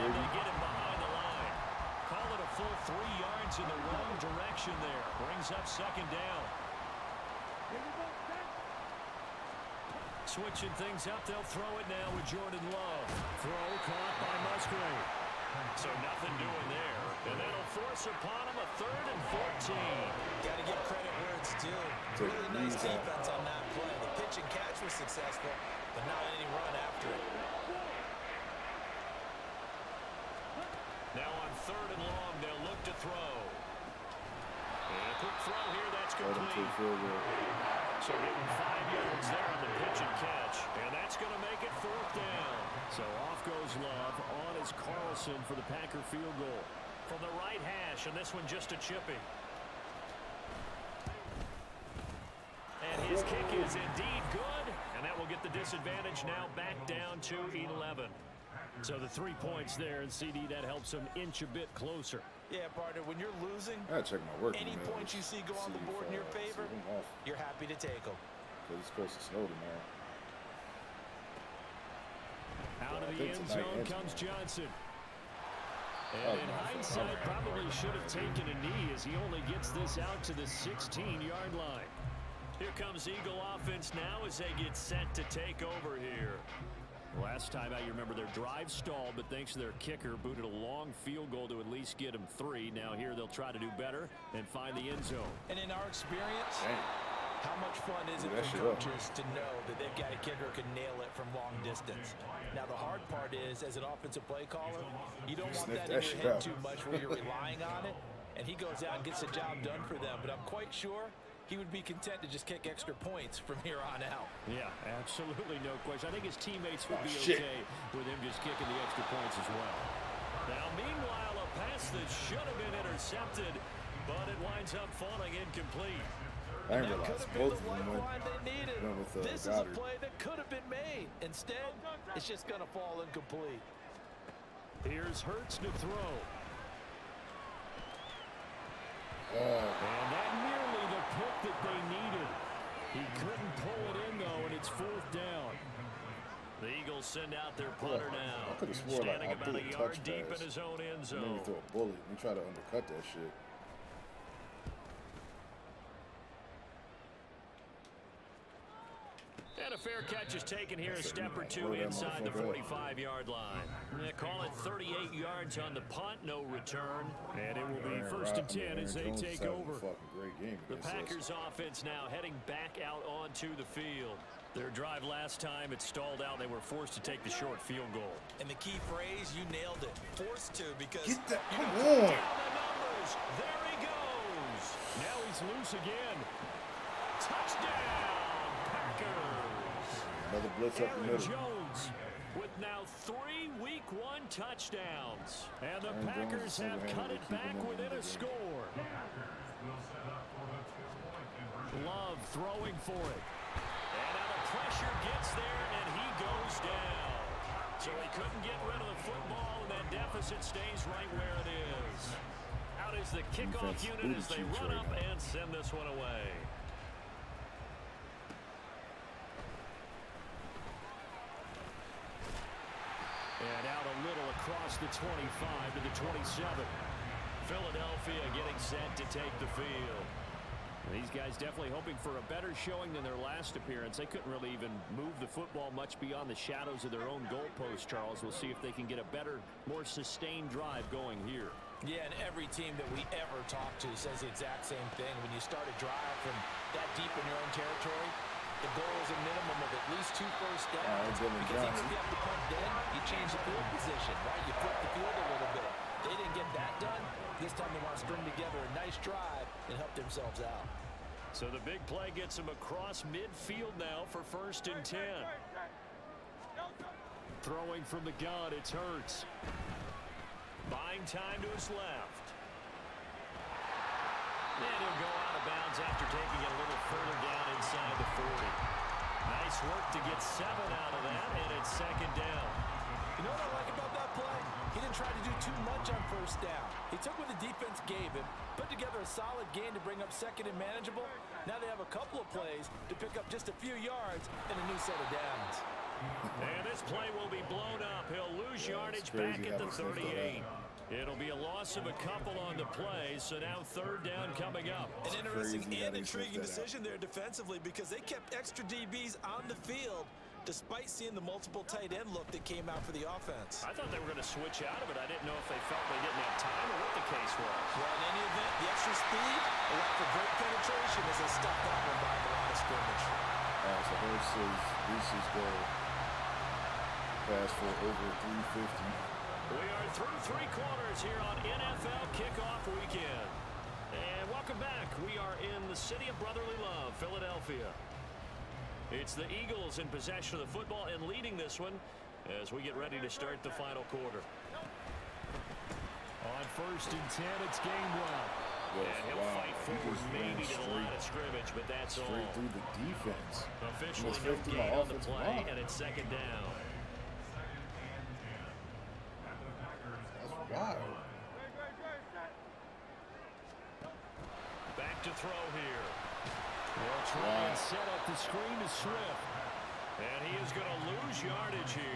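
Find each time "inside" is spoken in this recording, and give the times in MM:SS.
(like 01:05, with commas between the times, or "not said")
02:41, 04:37.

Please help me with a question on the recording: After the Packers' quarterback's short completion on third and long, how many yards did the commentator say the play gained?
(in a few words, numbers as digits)
5.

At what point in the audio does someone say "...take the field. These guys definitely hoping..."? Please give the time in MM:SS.
03:49.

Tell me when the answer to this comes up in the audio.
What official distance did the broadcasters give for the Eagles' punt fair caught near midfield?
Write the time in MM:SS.
02:44.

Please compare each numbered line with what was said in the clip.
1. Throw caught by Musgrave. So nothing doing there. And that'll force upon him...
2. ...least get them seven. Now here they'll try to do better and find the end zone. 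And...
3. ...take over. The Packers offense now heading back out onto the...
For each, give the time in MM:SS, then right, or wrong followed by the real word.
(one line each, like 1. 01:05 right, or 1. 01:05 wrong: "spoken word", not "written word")
1. 00:13 right
2. 01:31 wrong: "three", not "seven"
3. 02:49 right.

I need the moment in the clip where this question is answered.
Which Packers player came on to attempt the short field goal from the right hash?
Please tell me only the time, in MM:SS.
00:44.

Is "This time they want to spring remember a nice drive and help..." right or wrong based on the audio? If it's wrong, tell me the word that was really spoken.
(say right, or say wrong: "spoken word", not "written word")
wrong: "together", not "remember".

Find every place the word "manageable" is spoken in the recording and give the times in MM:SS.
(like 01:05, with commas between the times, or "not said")
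04:50.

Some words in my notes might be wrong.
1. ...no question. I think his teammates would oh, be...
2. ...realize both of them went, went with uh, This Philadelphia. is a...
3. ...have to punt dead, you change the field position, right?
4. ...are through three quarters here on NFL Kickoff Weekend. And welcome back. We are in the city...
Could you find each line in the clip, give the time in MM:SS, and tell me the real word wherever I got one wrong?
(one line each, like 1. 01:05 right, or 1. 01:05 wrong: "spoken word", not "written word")
1. 01:55 right
2. 02:06 wrong: "Goedert", not "Philadelphia"
3. 04:11 right
4. 05:29 right.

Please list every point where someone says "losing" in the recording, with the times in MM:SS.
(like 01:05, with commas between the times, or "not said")
01:03.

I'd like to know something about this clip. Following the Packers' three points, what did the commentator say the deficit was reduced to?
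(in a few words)
11.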